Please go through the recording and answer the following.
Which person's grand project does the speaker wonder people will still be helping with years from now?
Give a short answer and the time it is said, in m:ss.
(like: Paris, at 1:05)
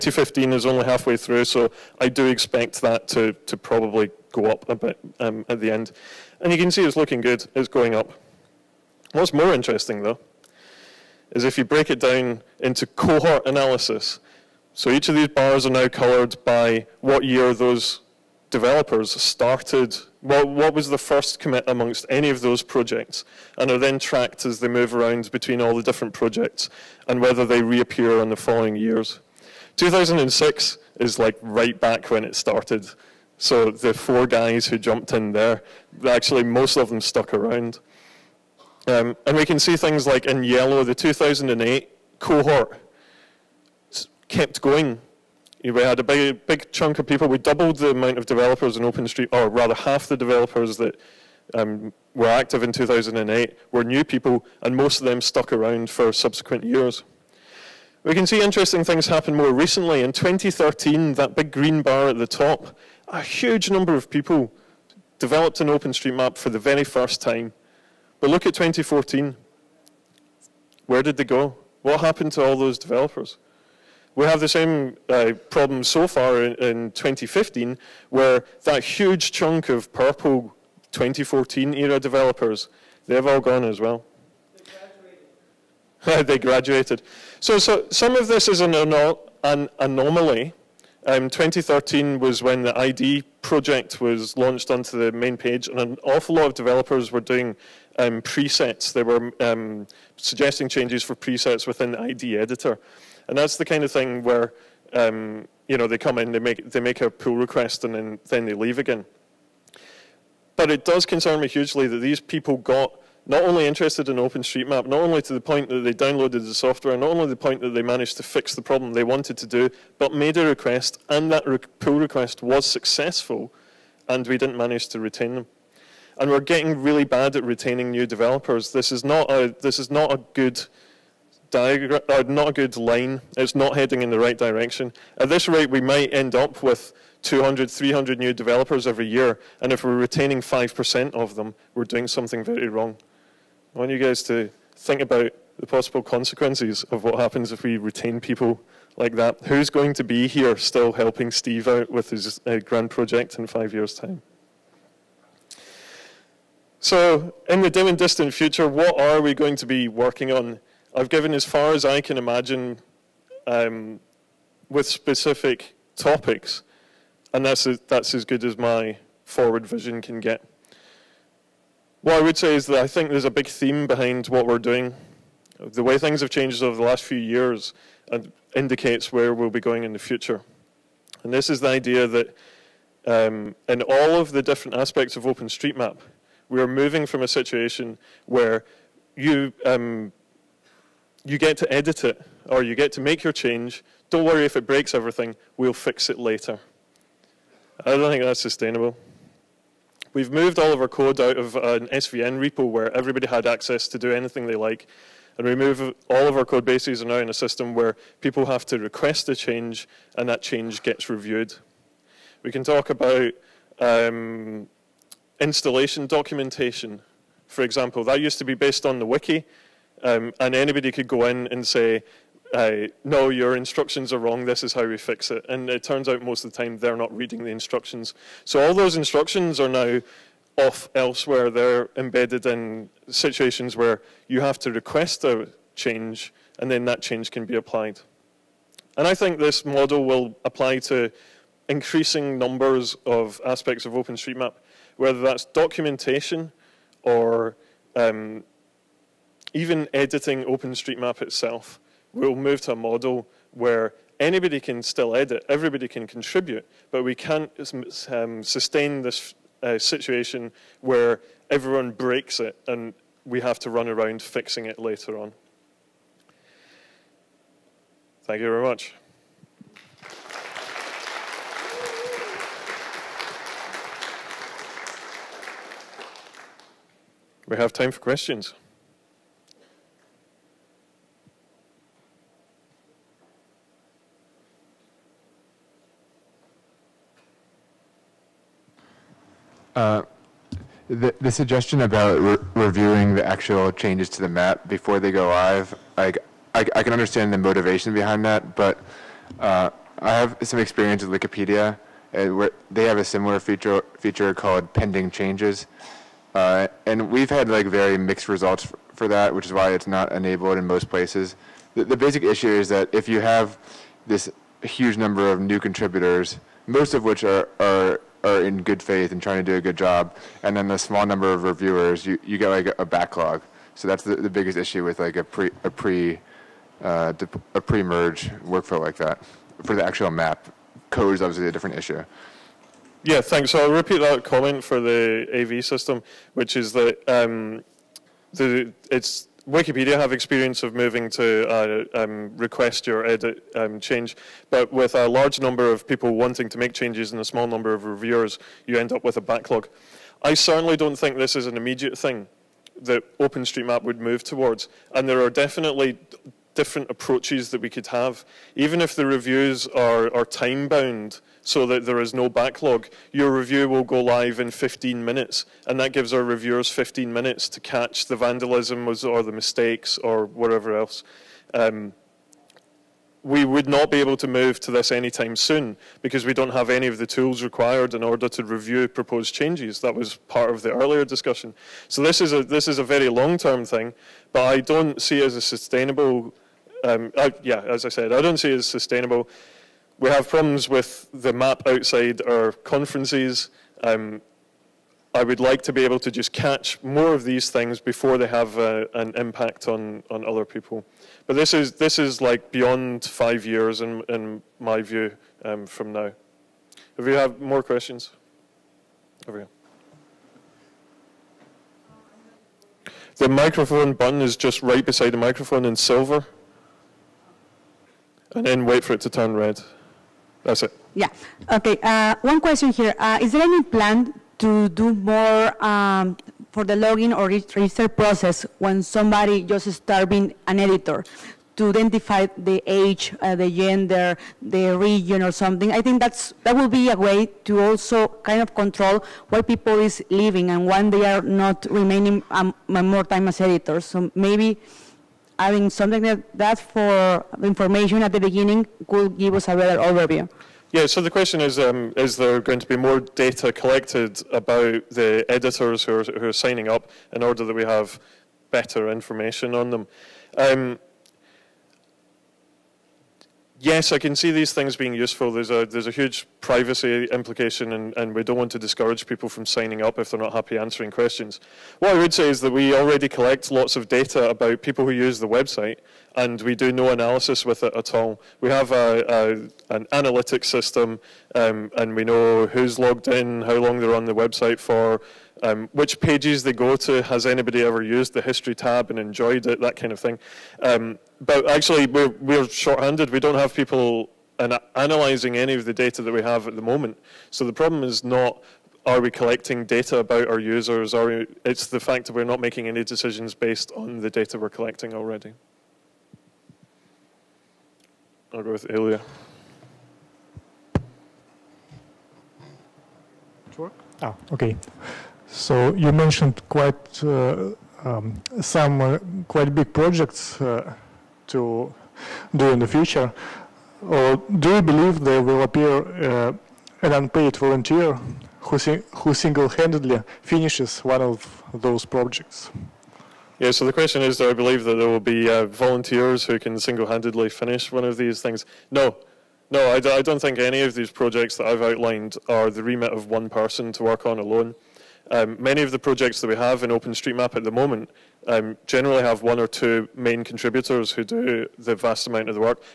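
Steve, at 2:31.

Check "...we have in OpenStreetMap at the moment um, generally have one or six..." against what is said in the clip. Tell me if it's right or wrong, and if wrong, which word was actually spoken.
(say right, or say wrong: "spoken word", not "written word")
wrong: "two", not "six".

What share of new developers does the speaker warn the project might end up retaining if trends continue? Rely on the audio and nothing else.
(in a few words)
5%.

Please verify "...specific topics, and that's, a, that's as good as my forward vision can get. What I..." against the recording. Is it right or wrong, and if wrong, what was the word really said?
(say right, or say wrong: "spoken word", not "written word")
right.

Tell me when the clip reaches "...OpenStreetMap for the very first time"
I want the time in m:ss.
1:05.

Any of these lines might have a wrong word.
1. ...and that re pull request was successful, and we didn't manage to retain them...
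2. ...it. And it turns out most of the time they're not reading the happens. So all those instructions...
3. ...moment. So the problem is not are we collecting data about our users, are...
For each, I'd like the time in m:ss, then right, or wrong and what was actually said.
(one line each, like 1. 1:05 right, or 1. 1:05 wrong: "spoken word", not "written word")
1. 2:01 right
2. 3:45 wrong: "instructions", not "happens"
3. 8:16 right.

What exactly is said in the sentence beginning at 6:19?
That was part of the earlier discussion.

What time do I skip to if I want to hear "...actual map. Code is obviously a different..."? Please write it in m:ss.
5:29.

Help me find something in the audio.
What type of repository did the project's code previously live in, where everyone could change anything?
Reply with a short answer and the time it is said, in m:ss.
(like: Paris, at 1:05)
SVN, at 3:21.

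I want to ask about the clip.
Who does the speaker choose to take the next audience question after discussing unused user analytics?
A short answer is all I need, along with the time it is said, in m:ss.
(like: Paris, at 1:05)
Ilya, at 8:28.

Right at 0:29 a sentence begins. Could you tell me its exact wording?
2006 is like right back when it started.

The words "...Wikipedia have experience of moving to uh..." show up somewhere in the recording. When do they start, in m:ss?
5:39.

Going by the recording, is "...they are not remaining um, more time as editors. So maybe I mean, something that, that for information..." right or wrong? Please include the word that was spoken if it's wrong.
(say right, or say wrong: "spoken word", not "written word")
right.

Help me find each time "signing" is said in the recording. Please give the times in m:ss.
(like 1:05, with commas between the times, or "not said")
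7:36, 7:49.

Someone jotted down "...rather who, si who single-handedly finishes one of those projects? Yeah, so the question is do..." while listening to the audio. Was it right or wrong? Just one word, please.
wrong.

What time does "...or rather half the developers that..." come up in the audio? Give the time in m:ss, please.
0:49.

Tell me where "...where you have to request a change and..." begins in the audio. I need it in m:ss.
3:53.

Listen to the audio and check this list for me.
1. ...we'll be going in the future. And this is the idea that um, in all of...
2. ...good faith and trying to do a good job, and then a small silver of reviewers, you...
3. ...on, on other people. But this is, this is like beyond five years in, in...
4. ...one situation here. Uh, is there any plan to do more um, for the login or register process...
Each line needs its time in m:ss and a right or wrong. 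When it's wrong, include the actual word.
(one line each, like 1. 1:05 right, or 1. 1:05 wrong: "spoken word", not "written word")
1. 2:59 right
2. 5:18 wrong: "number", not "silver"
3. 6:39 right
4. 7:02 wrong: "question", not "situation".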